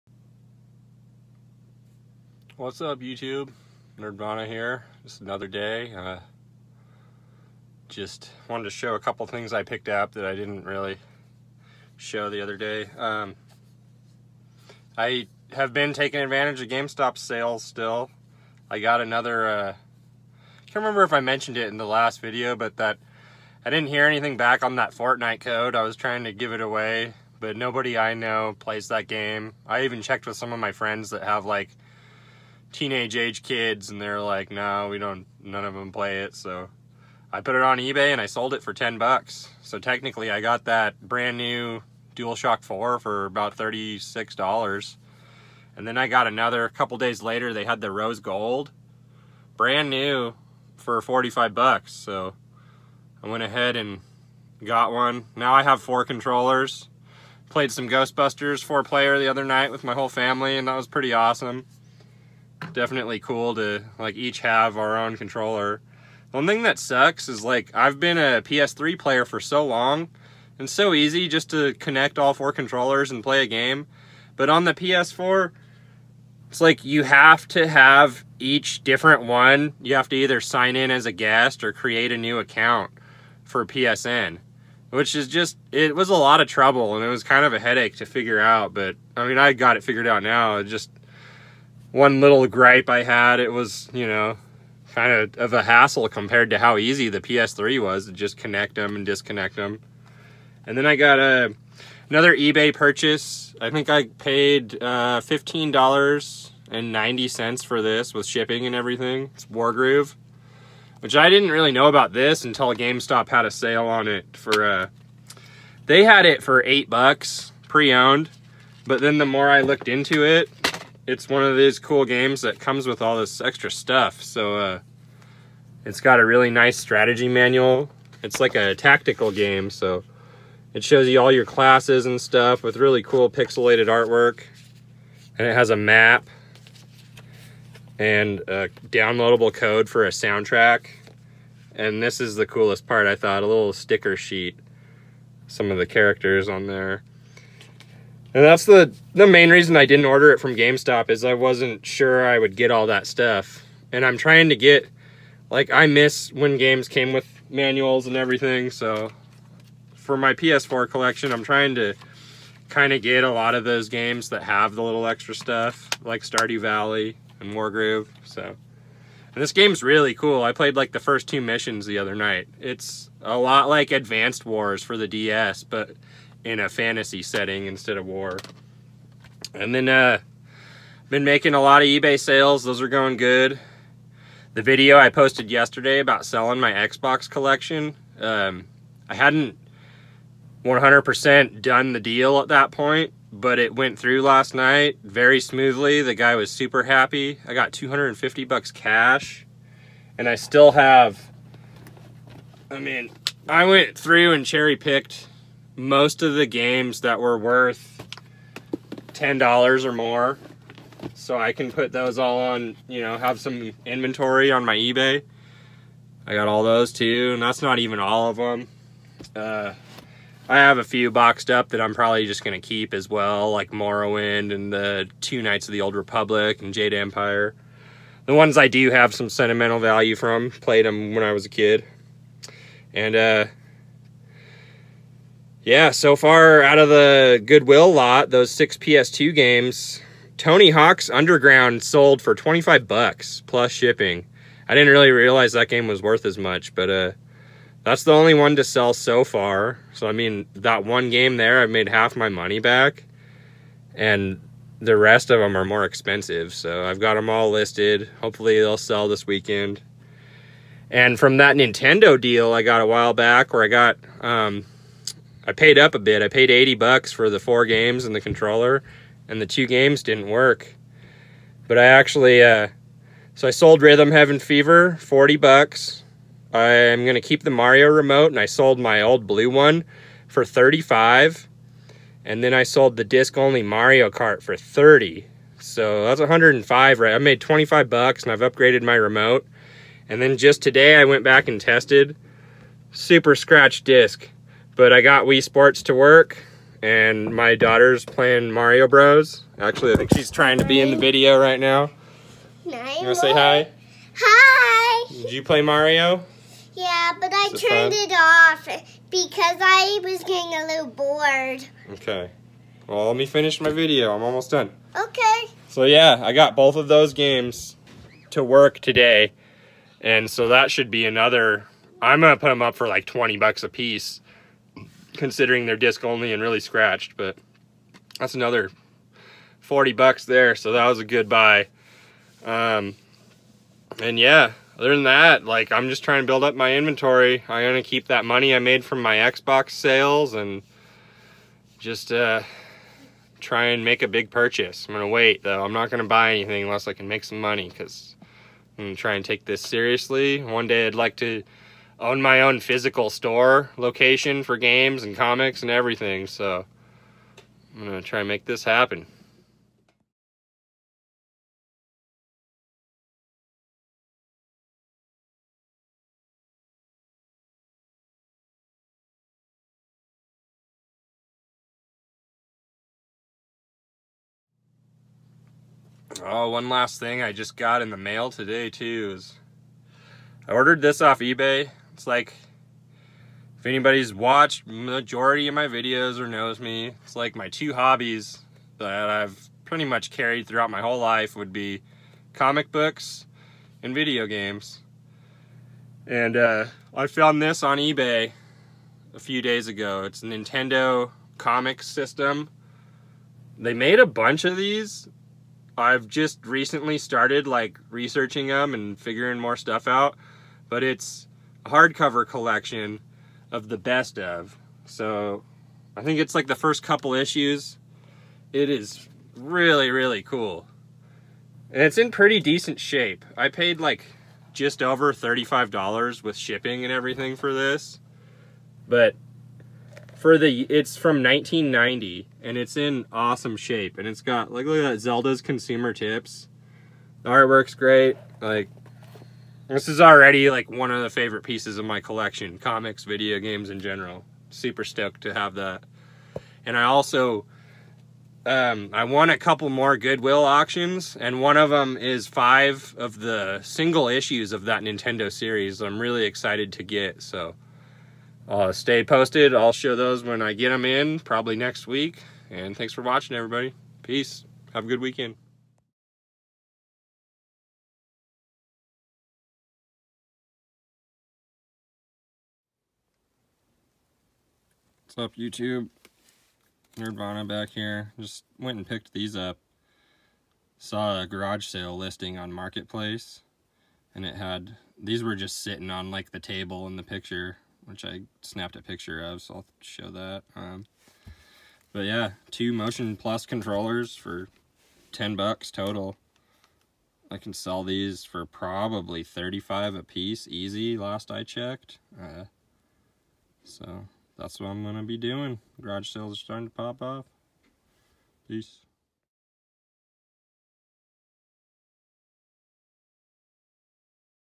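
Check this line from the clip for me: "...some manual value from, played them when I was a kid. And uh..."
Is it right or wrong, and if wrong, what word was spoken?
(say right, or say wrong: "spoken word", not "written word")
wrong: "sentimental", not "manual".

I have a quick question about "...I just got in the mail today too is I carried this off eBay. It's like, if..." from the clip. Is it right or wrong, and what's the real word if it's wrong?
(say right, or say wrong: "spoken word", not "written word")
wrong: "ordered", not "carried".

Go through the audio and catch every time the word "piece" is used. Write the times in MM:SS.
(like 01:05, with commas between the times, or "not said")
05:23, 07:21, 08:20.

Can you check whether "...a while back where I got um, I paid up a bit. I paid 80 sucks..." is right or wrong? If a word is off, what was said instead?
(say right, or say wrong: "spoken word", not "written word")
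wrong: "bucks", not "sucks".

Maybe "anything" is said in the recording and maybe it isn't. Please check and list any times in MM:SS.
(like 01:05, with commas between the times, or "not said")
00:24, 05:46.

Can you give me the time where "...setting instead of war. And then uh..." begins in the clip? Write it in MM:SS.
02:57.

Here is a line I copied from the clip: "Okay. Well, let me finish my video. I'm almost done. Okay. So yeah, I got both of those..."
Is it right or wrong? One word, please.
right.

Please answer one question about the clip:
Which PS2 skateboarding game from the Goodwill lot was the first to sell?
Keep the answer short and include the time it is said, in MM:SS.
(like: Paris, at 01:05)
Tony Hawk's Underground, at 04:00.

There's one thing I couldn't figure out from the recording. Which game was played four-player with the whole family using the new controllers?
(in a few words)
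Ghostbusters.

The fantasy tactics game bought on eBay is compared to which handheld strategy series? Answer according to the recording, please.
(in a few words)
Advanced Wars.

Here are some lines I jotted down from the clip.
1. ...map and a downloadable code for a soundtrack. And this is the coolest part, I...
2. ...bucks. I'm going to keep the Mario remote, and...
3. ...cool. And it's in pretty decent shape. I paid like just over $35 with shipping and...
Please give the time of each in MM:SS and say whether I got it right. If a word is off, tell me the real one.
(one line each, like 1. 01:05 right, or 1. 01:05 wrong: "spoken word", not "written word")
1. 02:15 right
2. 04:35 right
3. 07:00 right.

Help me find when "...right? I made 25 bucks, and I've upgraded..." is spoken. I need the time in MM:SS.
04:46.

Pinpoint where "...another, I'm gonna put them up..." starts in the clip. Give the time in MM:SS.
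05:21.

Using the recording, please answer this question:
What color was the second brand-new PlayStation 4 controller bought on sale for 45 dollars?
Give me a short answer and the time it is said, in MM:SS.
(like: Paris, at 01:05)
Rose gold, at 00:47.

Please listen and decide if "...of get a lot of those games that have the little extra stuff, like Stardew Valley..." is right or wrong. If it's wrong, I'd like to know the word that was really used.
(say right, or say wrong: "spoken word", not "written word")
right.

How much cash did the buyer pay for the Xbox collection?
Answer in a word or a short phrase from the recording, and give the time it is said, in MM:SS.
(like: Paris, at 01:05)
$250, at 03:17.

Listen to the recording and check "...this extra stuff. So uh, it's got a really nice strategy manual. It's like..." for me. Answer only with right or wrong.
right.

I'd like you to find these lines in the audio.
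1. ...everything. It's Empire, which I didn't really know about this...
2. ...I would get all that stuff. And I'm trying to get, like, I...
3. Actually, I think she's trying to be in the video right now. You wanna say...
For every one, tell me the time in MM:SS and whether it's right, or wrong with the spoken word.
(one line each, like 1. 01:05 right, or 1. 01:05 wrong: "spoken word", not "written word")
1. 01:48 wrong: "Wargroove", not "Empire"
2. 02:32 right
3. 04:59 right.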